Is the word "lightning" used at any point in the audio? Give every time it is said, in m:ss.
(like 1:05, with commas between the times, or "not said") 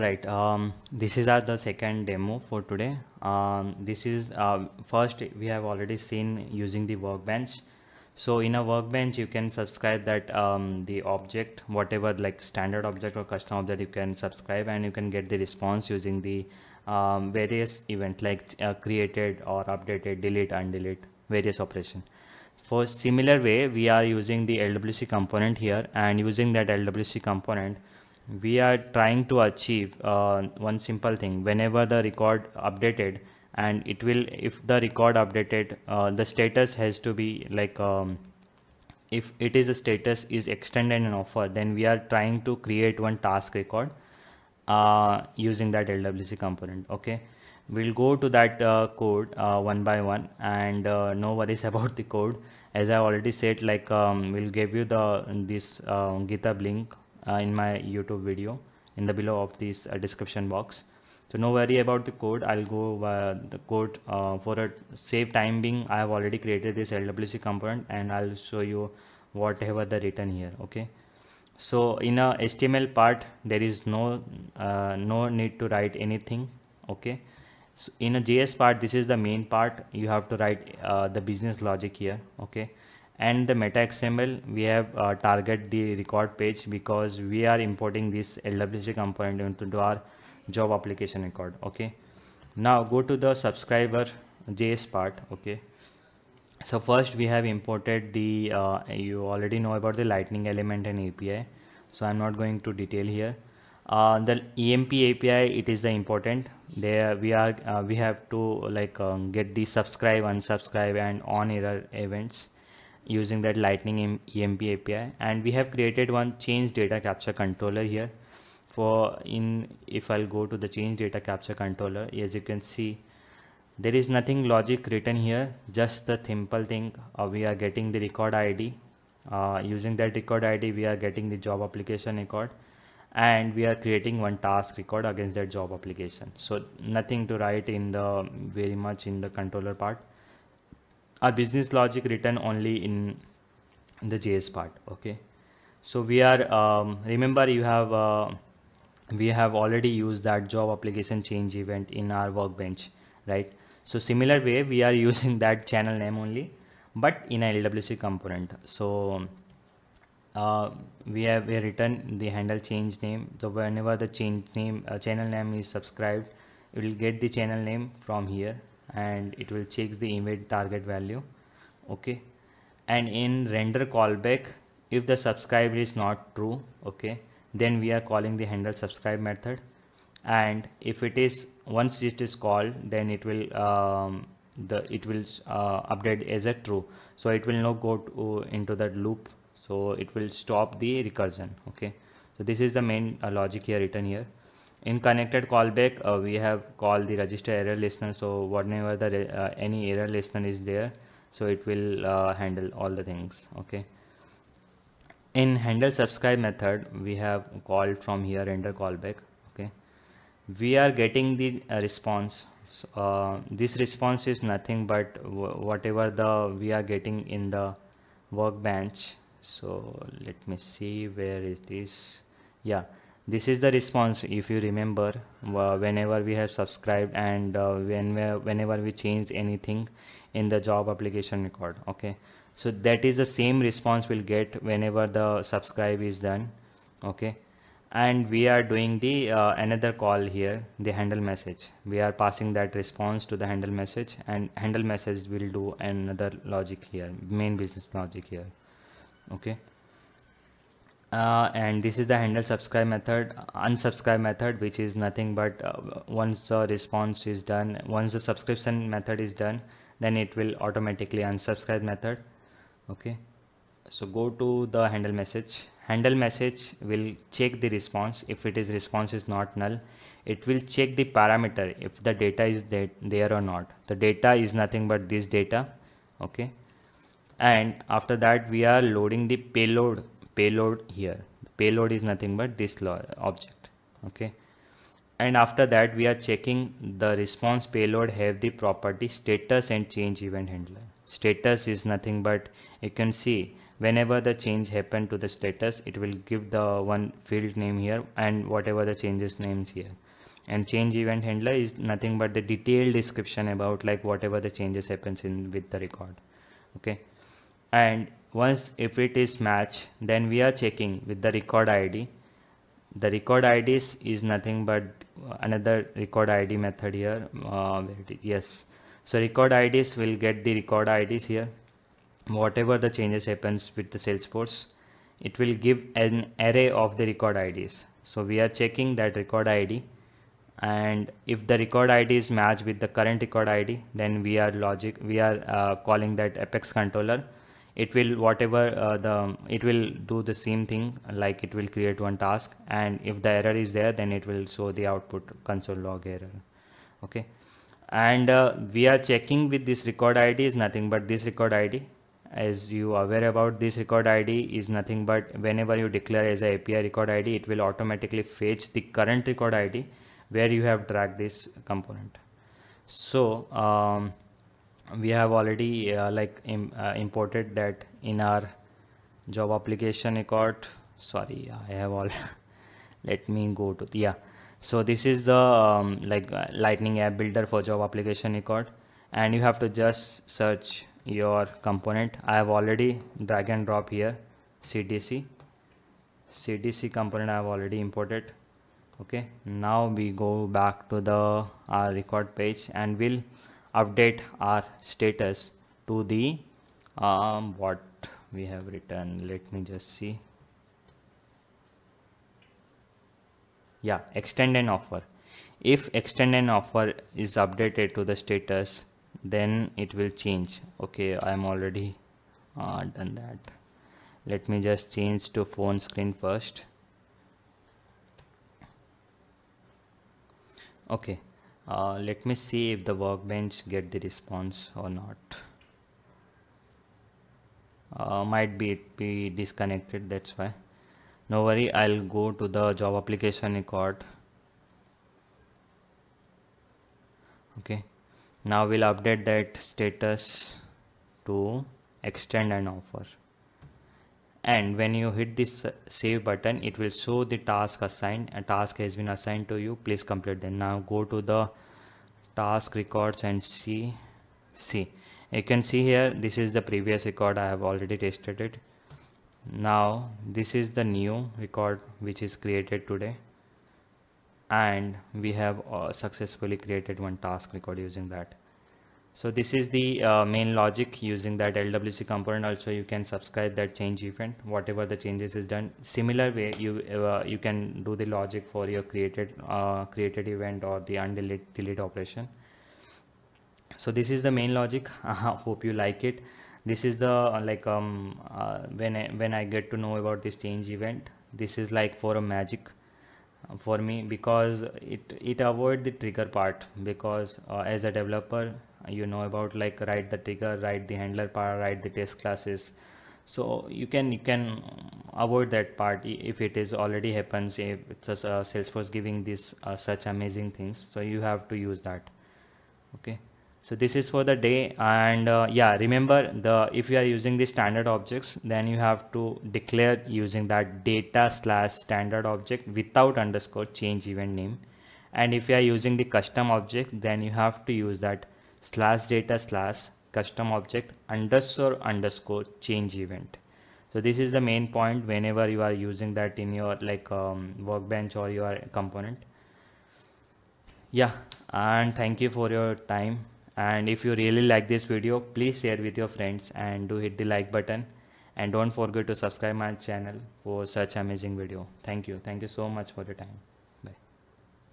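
1:40, 1:53, 6:16.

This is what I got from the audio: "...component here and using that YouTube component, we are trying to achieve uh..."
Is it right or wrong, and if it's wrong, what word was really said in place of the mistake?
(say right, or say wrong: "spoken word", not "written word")
wrong: "LWC", not "YouTube".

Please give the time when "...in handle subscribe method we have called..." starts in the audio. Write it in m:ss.
3:25.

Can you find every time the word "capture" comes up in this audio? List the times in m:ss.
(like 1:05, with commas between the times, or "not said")
1:57, 2:01.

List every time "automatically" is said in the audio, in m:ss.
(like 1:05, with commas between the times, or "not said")
4:20, 5:57.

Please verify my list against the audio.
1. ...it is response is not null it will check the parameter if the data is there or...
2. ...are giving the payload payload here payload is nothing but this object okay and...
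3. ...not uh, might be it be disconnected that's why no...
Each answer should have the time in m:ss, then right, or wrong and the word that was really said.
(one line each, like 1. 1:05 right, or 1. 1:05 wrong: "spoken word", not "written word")
1. 4:28 right
2. 4:38 wrong: "loading", not "giving"
3. 7:04 right.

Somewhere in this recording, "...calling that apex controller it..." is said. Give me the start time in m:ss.
5:35.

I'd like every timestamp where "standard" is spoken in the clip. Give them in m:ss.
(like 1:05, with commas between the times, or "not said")
0:12, 8:37, 8:41.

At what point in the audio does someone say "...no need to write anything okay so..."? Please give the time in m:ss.
1:14.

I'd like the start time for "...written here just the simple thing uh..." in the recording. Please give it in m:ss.
2:04.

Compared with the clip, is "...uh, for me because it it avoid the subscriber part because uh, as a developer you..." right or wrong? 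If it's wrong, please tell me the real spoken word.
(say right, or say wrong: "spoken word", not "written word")
wrong: "trigger", not "subscriber".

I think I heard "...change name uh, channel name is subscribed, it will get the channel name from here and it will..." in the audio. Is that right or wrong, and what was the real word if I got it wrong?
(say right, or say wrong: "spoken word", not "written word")
right.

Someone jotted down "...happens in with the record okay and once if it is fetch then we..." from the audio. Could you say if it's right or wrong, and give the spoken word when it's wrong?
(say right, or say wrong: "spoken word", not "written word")
wrong: "match", not "fetch".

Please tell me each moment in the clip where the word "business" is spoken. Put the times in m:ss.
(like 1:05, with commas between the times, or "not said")
1:21, 2:21, 4:07.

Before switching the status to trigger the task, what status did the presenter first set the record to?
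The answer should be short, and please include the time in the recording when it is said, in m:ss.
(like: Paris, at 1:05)
Phone screen, at 6:55.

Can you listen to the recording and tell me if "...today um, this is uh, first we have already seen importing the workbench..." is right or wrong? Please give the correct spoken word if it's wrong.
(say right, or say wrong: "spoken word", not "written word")
wrong: "using", not "importing".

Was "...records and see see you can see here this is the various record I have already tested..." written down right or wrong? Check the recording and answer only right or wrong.
wrong.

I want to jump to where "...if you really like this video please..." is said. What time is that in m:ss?
9:03.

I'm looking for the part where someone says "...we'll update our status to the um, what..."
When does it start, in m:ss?
6:32.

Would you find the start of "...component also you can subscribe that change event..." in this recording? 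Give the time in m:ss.
7:52.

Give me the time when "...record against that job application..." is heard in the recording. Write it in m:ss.
2:14.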